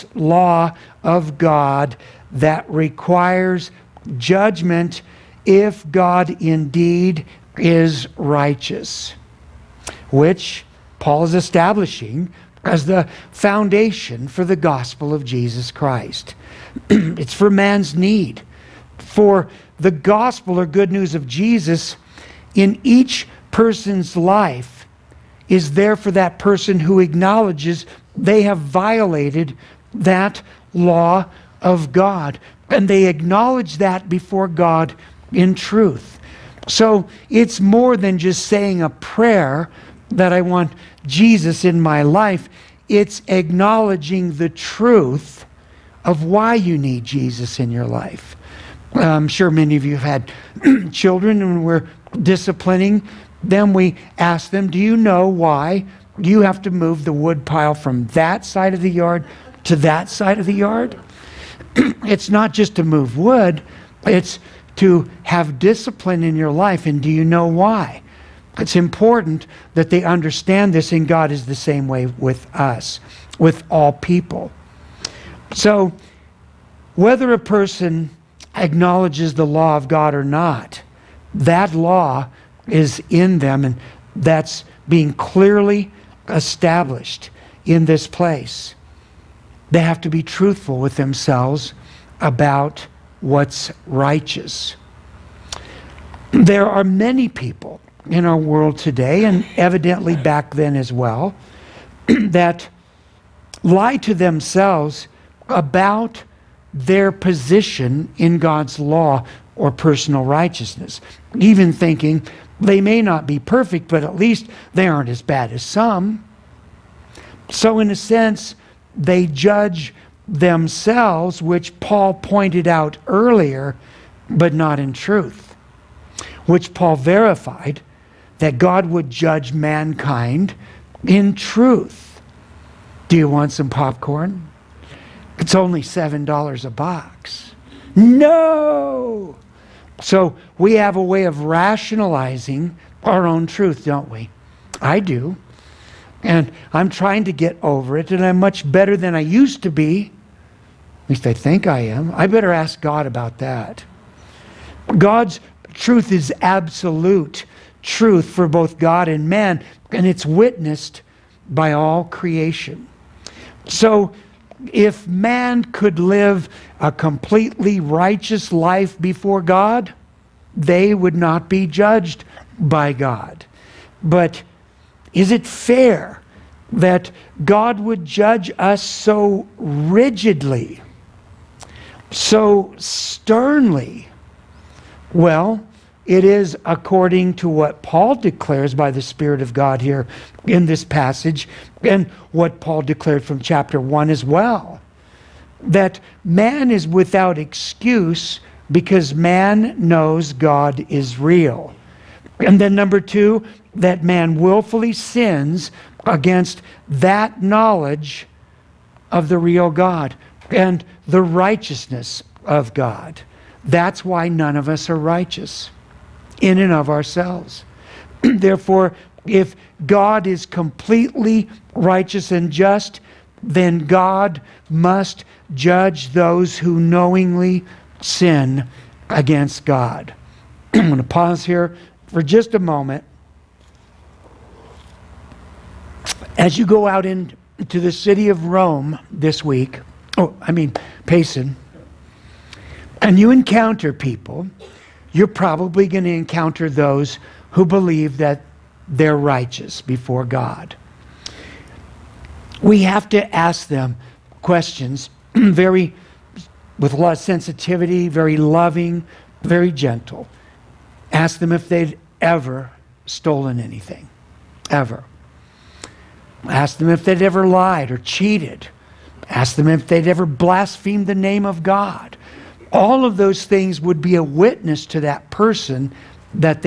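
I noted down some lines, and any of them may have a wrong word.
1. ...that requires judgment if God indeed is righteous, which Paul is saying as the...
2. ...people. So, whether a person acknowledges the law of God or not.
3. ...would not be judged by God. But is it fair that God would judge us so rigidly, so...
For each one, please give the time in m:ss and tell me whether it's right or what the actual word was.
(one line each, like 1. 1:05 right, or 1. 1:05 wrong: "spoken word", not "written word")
1. 0:02 wrong: "establishing", not "saying"
2. 1:13 right
3. 2:50 right.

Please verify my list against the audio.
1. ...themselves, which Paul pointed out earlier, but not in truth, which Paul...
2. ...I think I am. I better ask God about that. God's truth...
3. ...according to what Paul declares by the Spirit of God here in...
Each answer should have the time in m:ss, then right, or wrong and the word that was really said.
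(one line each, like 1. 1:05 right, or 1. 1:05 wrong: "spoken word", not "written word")
1. 2:00 right
2. 2:31 right
3. 3:06 right.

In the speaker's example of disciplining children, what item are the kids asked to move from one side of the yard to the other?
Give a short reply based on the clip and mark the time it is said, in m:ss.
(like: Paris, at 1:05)
wood pile, at 0:57.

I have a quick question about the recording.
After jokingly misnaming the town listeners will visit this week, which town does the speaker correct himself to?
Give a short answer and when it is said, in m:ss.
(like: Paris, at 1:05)
Payson, at 4:01.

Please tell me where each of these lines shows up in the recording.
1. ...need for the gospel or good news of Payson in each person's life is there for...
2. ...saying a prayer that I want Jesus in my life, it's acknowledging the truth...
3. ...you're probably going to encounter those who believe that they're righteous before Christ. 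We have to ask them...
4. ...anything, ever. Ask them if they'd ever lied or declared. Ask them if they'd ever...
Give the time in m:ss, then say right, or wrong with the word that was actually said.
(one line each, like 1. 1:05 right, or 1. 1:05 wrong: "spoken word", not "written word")
1. 0:17 wrong: "Jesus", not "Payson"
2. 0:38 right
3. 4:05 wrong: "God", not "Christ"
4. 4:23 wrong: "cheated", not "declared".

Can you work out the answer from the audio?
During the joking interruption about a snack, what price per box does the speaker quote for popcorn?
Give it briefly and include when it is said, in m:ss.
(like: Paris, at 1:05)
$7, at 2:15.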